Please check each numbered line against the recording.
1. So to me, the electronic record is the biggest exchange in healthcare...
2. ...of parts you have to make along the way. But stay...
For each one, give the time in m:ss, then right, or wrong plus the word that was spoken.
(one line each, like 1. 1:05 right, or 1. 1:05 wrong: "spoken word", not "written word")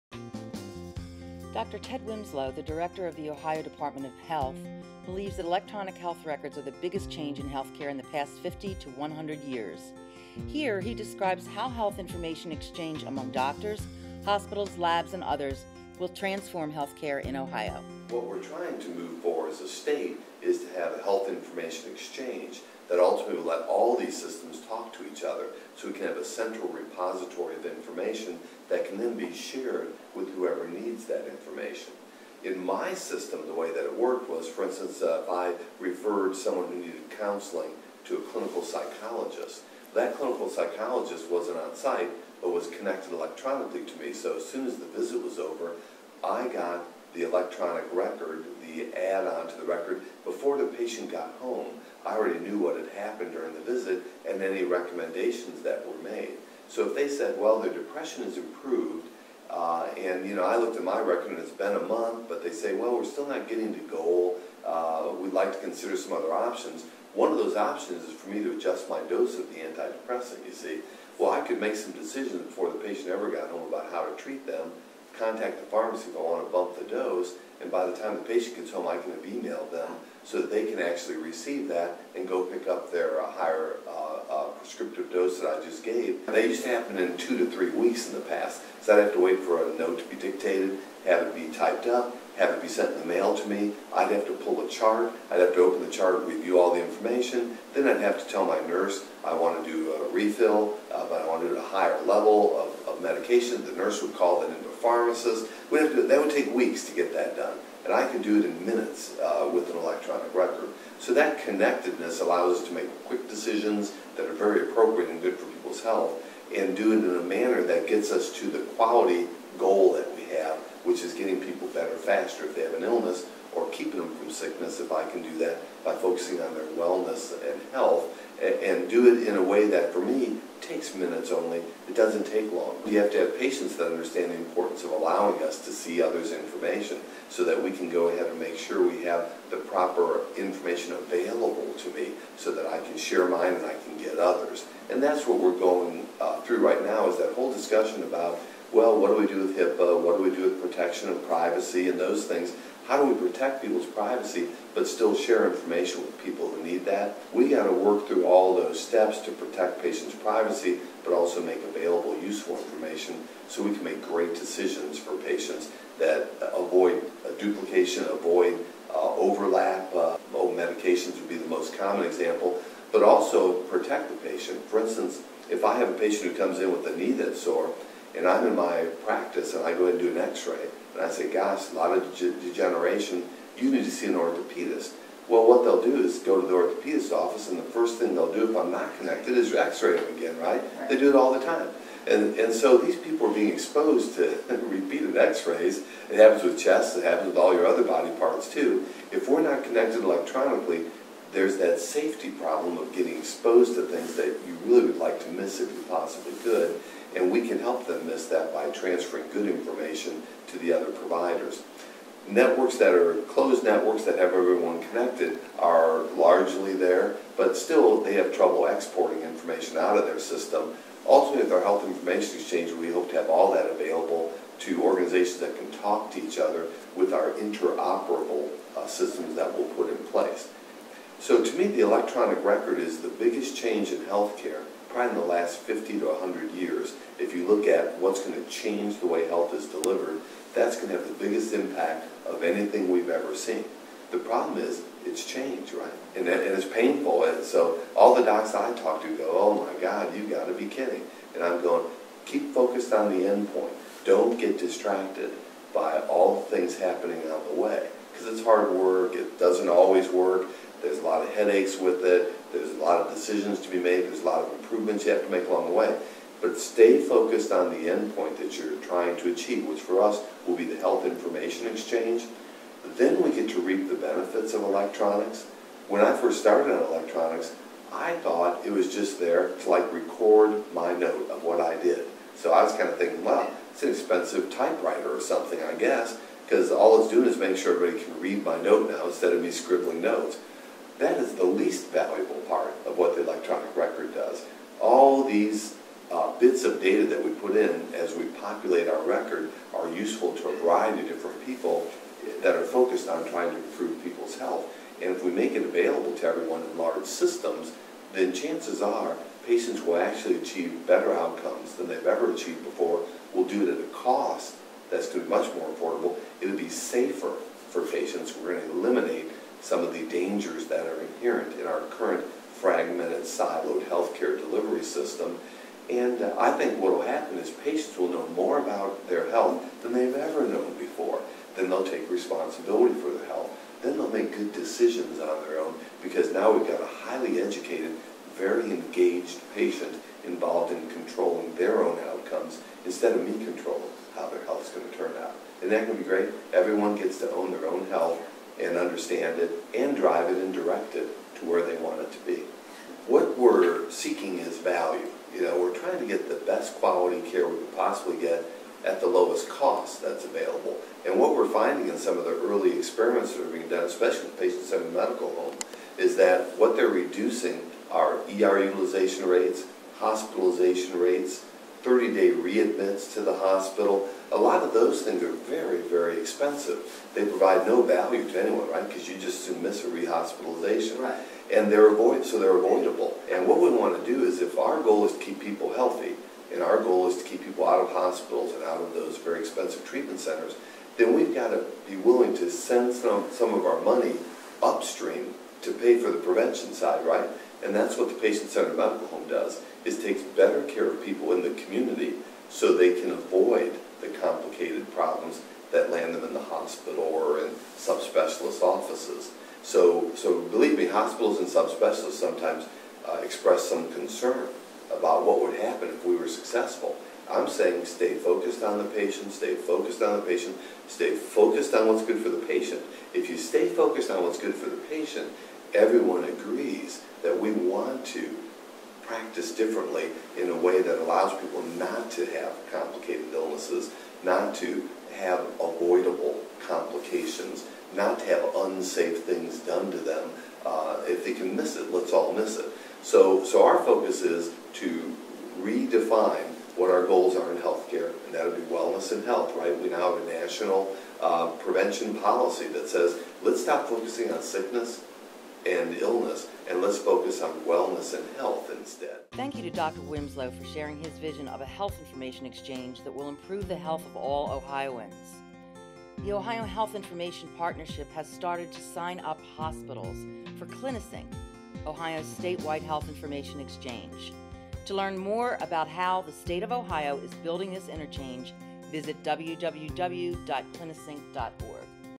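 1. 3:51 wrong: "change", not "exchange"
2. 4:24 wrong: "improvements", not "parts".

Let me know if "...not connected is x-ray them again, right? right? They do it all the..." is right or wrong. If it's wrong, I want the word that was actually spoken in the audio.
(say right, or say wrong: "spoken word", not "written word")
right.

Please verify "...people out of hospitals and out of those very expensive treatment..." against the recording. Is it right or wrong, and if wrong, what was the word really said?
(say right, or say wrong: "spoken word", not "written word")
right.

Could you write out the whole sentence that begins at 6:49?
So, so believe me, hospitals and subspecialists sometimes uh, express some concern about what would happen if we were successful.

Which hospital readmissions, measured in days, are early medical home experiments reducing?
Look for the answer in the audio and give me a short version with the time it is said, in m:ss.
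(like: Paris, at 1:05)
30-day readmits, at 6:11.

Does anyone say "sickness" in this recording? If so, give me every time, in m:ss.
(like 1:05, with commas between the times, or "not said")
2:04, 7:34.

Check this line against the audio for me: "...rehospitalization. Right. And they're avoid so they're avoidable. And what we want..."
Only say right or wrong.
right.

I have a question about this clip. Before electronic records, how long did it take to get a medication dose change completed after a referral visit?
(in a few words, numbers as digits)
two to three weeks.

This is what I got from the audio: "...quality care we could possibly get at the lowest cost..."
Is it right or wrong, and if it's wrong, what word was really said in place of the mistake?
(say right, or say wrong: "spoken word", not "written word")
right.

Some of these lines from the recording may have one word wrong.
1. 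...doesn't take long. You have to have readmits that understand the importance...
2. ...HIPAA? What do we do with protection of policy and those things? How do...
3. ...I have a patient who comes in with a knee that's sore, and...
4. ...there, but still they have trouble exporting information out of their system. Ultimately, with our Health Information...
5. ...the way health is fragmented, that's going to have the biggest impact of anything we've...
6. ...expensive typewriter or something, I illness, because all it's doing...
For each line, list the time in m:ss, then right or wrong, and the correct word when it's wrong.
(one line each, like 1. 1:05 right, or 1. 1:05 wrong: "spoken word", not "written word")
1. 2:11 wrong: "patients", not "readmits"
2. 2:29 wrong: "privacy", not "policy"
3. 2:55 right
4. 3:36 right
5. 3:58 wrong: "delivered", not "fragmented"
6. 4:43 wrong: "guess", not "illness".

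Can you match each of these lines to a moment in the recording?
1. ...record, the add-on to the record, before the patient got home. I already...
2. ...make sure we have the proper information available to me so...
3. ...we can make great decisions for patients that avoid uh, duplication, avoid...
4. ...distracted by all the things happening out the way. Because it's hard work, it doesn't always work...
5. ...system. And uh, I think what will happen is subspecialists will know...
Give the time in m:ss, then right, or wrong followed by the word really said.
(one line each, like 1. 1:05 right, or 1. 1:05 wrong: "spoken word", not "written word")
1. 0:47 right
2. 2:18 right
3. 2:43 right
4. 4:14 right
5. 5:24 wrong: "patients", not "subspecialists".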